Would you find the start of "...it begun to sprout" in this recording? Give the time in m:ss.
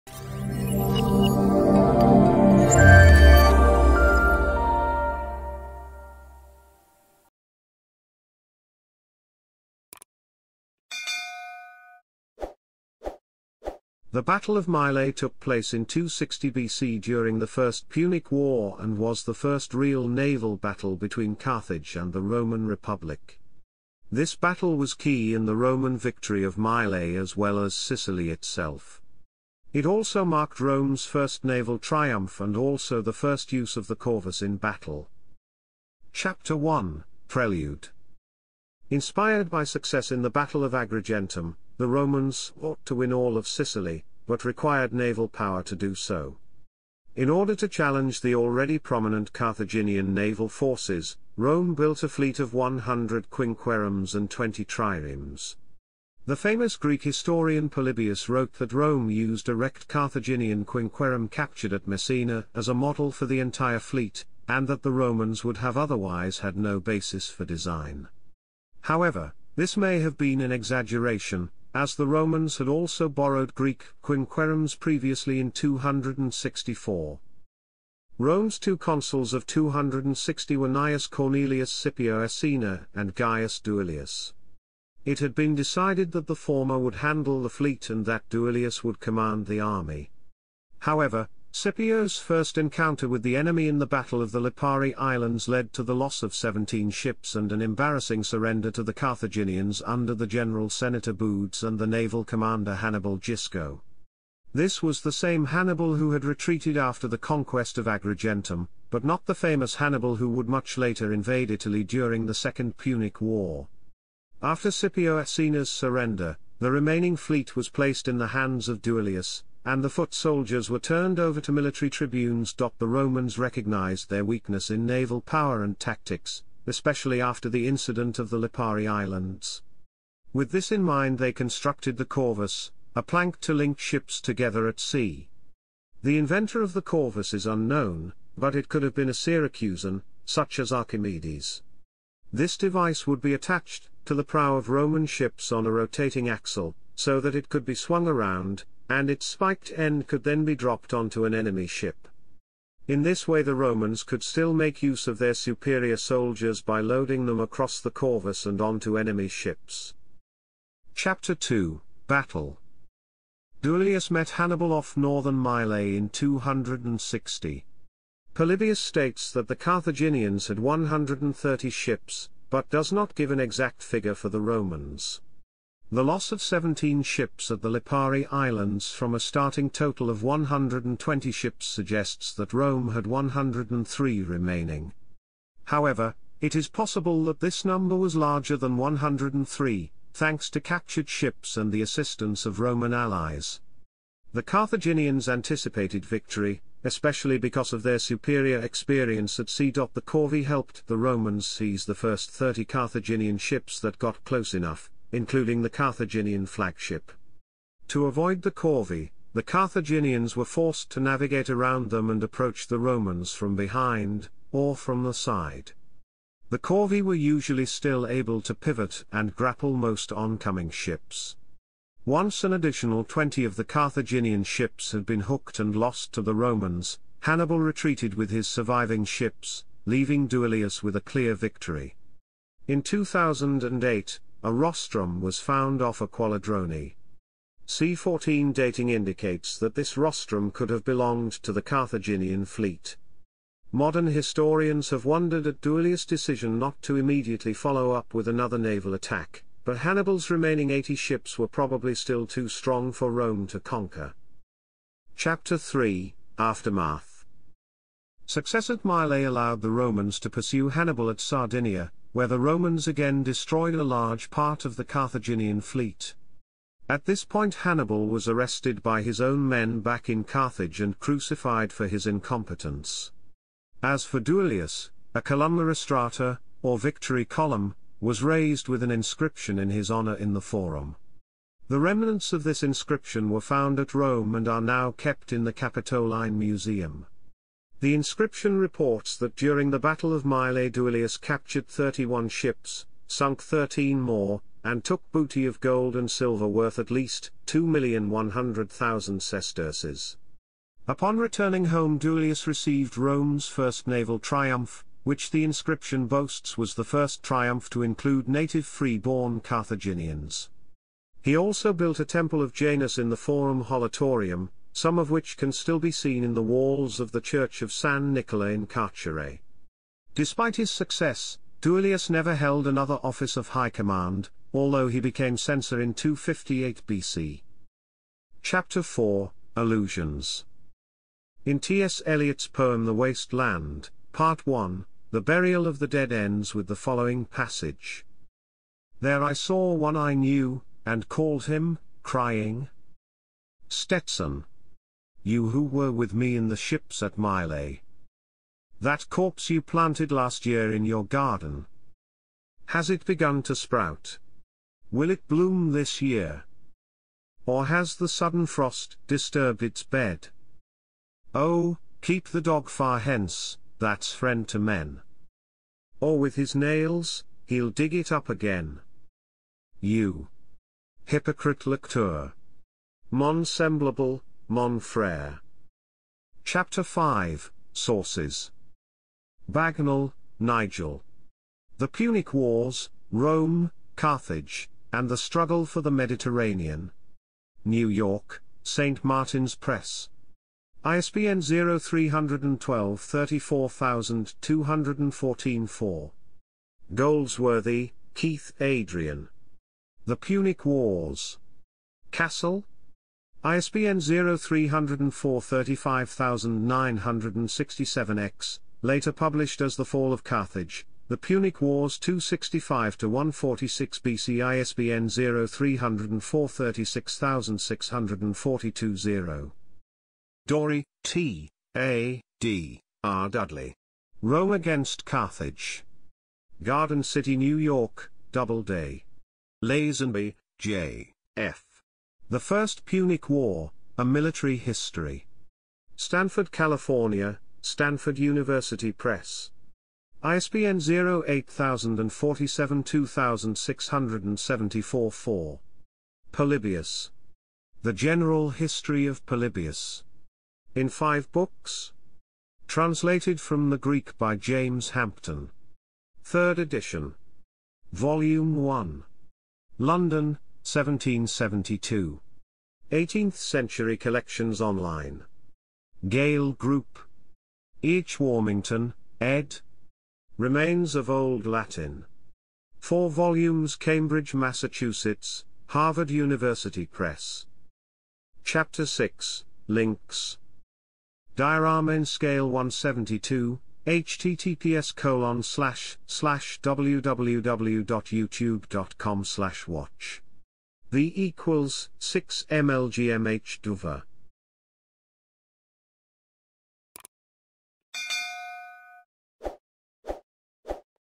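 5:52.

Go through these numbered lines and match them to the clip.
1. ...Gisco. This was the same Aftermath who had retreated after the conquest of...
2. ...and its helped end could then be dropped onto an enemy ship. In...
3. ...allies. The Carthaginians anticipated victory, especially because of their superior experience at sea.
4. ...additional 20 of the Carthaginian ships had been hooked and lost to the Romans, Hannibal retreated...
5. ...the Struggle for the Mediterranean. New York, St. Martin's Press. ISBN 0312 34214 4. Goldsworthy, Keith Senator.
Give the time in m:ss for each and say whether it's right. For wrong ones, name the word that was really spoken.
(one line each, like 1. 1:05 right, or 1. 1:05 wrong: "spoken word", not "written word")
1. 1:43 wrong: "Hannibal", not "Aftermath"
2. 2:28 wrong: "spiked", not "helped"
3. 3:12 right
4. 3:42 right
5. 6:25 wrong: "Adrian", not "Senator".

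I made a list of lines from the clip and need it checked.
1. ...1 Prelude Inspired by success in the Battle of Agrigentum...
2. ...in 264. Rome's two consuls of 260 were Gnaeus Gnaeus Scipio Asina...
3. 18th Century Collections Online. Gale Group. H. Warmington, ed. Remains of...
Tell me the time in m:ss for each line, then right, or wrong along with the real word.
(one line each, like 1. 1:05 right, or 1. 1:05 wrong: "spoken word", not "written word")
1. 0:36 right
2. 1:15 wrong: "Cornelius", not "Gnaeus"
3. 7:42 right.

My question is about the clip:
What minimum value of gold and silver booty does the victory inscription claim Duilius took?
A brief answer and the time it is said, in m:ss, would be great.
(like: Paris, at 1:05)
2,100,000 sesterces, at 4:57.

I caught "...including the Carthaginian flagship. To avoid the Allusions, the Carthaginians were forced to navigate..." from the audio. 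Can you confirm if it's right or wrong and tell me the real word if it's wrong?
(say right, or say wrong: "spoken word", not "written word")
wrong: "Corvi", not "Allusions".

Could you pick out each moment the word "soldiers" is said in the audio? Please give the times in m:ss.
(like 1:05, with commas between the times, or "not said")
2:00, 2:35.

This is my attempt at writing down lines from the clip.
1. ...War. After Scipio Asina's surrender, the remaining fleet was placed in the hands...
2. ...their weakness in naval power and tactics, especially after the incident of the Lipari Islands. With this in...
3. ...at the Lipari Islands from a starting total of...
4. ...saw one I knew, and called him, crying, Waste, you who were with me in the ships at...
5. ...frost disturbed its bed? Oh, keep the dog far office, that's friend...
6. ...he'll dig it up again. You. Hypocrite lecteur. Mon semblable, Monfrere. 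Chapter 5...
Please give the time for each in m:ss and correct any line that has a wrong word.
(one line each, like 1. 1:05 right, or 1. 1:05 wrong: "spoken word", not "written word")
1. 1:53 right
2. 2:04 right
3. 2:57 right
4. 5:39 wrong: "Stetson", not "Waste"
5. 5:58 wrong: "hence", not "office"
6. 6:07 right.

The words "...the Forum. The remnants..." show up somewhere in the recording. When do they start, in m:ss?
4:40.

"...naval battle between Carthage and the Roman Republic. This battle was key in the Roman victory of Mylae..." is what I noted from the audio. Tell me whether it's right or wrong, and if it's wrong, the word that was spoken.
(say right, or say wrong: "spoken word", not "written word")
right.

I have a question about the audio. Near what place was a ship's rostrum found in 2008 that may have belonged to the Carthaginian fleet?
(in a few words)
Acqualadroni.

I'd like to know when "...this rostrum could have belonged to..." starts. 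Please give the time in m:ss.
3:59.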